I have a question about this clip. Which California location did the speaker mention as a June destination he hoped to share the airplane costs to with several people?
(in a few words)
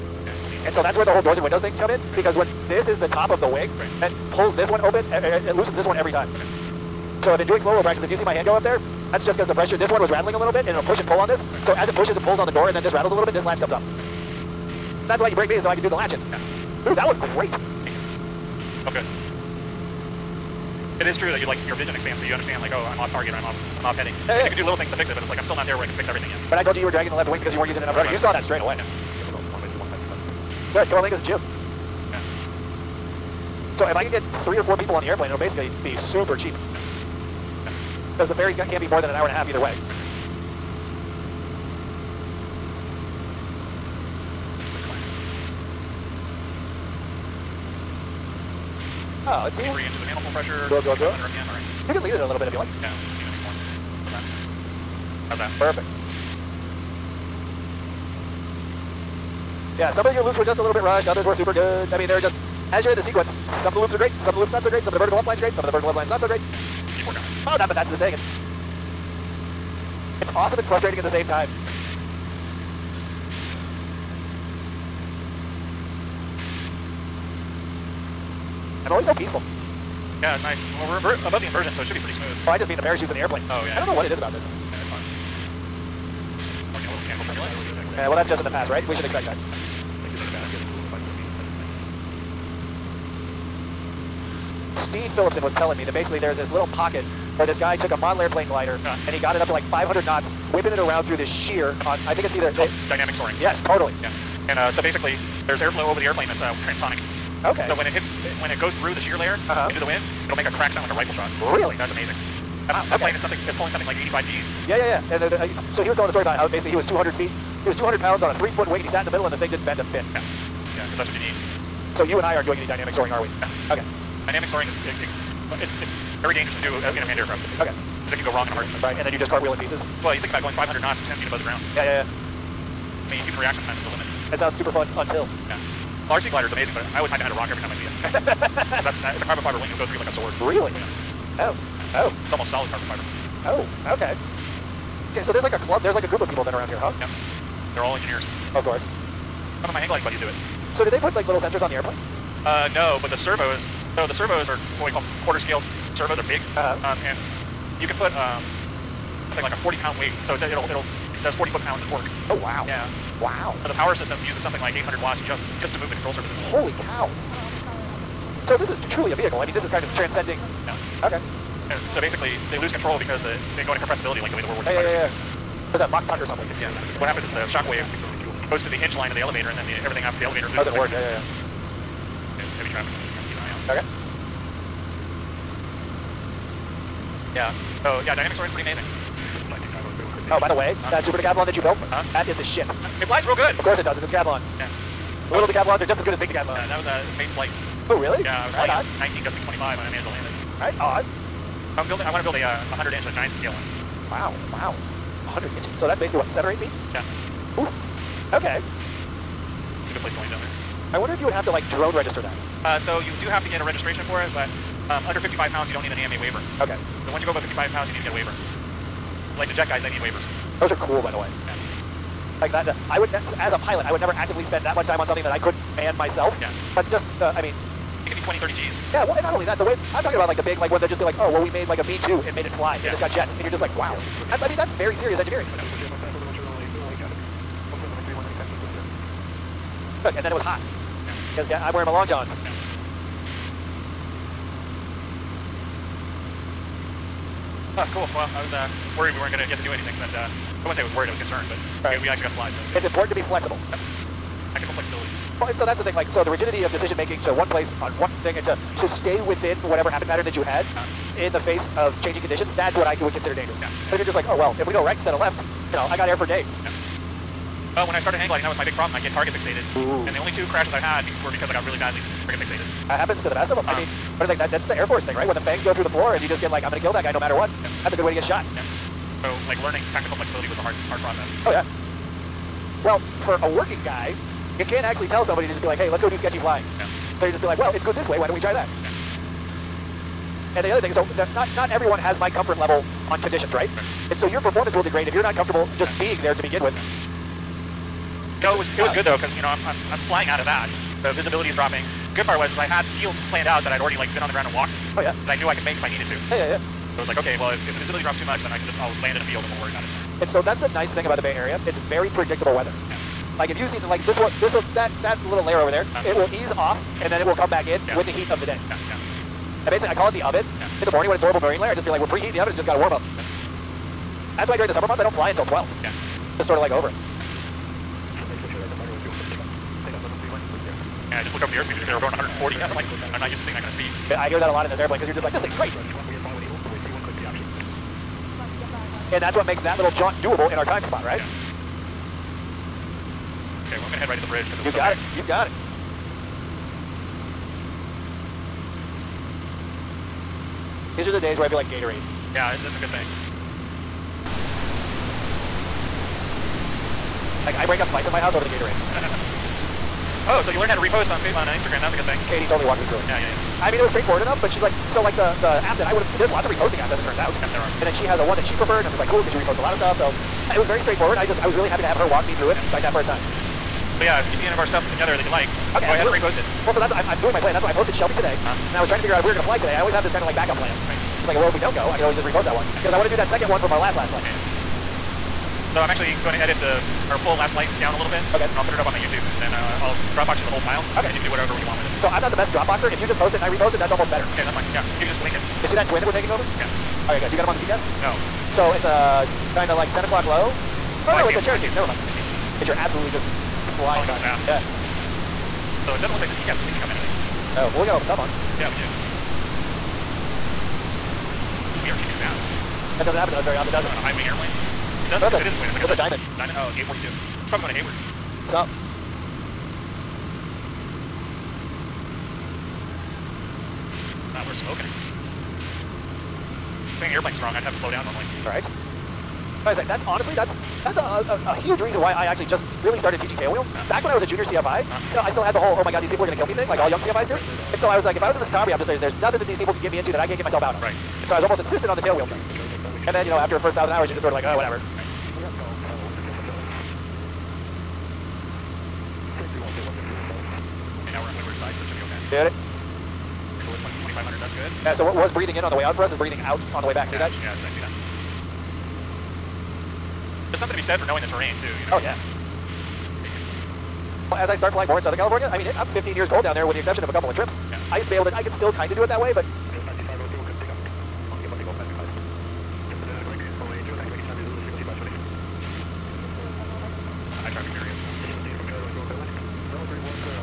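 Coalinga.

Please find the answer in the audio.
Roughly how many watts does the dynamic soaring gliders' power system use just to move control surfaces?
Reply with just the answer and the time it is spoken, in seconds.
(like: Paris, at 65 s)
800 watts, at 164 s.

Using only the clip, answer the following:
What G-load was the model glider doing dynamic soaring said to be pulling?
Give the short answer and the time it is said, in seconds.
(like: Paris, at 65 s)
85 Gs, at 114 s.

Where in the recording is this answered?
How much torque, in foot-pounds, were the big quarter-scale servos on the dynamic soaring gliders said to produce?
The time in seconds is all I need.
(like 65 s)
161 s.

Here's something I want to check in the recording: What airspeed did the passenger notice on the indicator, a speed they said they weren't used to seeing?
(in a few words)
140.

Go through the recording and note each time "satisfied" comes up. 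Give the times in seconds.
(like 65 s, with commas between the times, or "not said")
not said.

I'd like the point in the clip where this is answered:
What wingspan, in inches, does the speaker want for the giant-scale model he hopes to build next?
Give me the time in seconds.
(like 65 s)
202 s.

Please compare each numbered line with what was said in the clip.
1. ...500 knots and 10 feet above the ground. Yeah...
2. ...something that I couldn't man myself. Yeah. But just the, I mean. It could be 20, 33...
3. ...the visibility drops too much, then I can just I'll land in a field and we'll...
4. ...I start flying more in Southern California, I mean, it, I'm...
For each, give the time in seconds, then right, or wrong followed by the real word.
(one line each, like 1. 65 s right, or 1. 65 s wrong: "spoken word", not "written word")
1. 130 s right
2. 225 s wrong: "30", not "33"
3. 307 s right
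4. 464 s right.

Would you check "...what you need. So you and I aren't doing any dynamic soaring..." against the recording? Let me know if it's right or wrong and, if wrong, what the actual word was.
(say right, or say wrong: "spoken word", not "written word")
right.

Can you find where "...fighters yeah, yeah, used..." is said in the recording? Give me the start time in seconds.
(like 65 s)
174 s.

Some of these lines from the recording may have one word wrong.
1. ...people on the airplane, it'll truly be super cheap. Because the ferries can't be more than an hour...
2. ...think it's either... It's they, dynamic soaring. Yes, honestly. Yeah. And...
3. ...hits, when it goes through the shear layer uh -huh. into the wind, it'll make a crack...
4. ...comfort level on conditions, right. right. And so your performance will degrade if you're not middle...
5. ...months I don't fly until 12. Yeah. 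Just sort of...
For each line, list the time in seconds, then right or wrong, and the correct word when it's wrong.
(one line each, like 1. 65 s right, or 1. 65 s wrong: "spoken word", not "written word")
1. 34 s wrong: "basically", not "truly"
2. 102 s wrong: "totally", not "honestly"
3. 107 s right
4. 292 s wrong: "comfortable", not "middle"
5. 324 s right.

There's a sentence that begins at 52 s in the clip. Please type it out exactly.
Yeah, need a new How's that?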